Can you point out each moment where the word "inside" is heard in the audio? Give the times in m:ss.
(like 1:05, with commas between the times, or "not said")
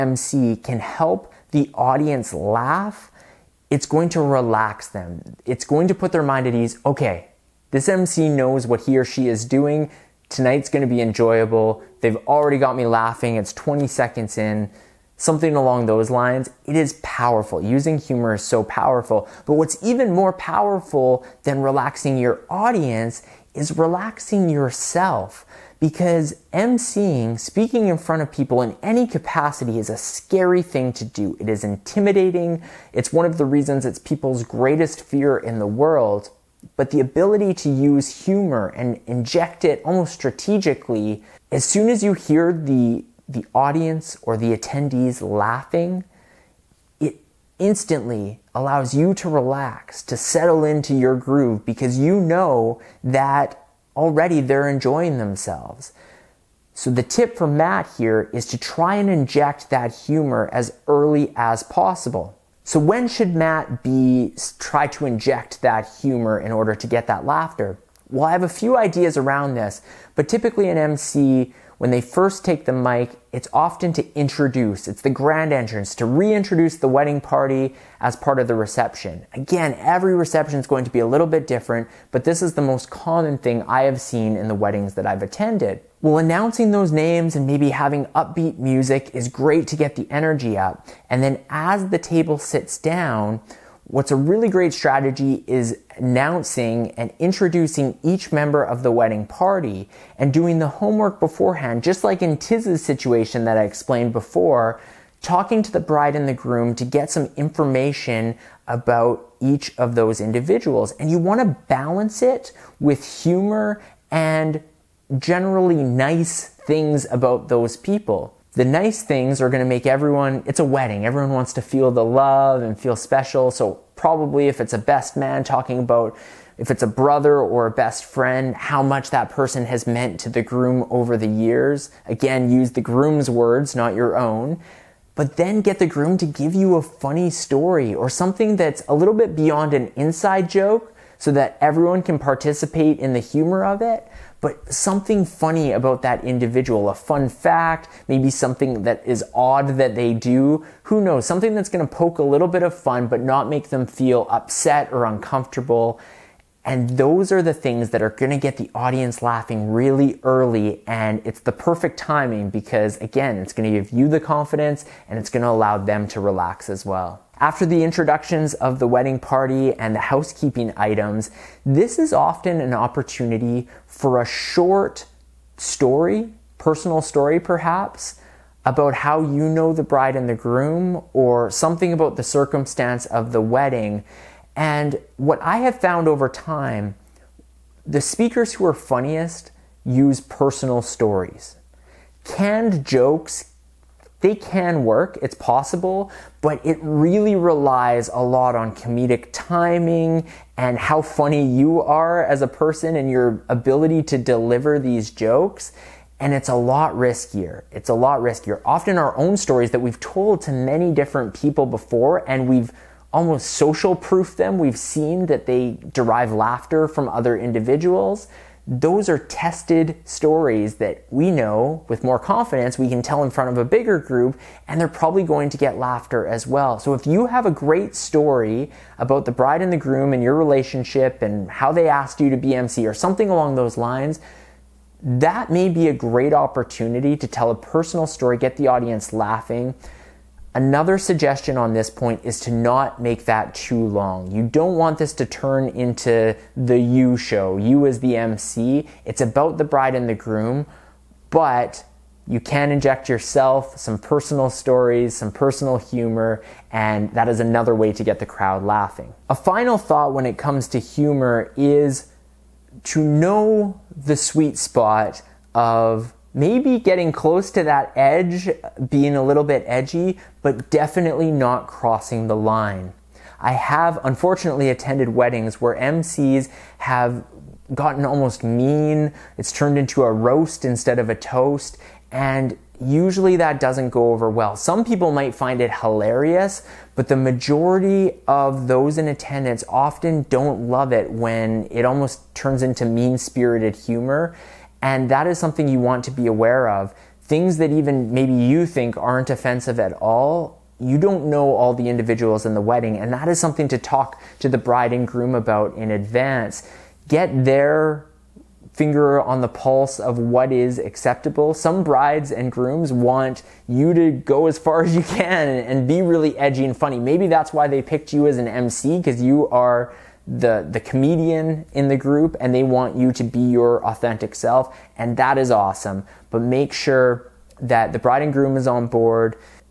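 2:19.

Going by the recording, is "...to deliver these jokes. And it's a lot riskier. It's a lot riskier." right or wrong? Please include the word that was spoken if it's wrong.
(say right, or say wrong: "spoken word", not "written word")
right.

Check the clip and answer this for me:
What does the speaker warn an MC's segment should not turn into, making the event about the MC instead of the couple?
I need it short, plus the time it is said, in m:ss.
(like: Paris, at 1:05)
The you show, at 4:06.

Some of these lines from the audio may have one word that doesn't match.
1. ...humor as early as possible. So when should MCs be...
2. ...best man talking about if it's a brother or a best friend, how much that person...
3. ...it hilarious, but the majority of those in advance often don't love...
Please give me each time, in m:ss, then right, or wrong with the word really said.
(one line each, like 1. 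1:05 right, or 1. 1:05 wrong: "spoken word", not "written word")
1. 0:59 wrong: "Matt", not "MCs"
2. 2:04 right
3. 4:45 wrong: "attendance", not "advance".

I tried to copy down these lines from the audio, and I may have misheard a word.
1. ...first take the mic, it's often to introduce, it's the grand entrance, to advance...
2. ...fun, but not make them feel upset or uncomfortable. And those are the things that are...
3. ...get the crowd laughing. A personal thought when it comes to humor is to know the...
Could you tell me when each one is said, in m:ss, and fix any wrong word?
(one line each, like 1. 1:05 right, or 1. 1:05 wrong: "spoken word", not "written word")
1. 1:11 wrong: "reintroduce", not "advance"
2. 2:32 right
3. 4:18 wrong: "final", not "personal".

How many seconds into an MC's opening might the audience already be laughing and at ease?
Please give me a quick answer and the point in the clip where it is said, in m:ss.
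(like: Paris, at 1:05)
20 seconds, at 0:13.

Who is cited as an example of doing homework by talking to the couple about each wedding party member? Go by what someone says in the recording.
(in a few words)
Tiz.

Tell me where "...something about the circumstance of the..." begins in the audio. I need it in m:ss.
3:01.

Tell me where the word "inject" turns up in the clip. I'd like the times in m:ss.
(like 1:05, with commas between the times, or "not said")
0:39, 0:59, 1:05, 4:12.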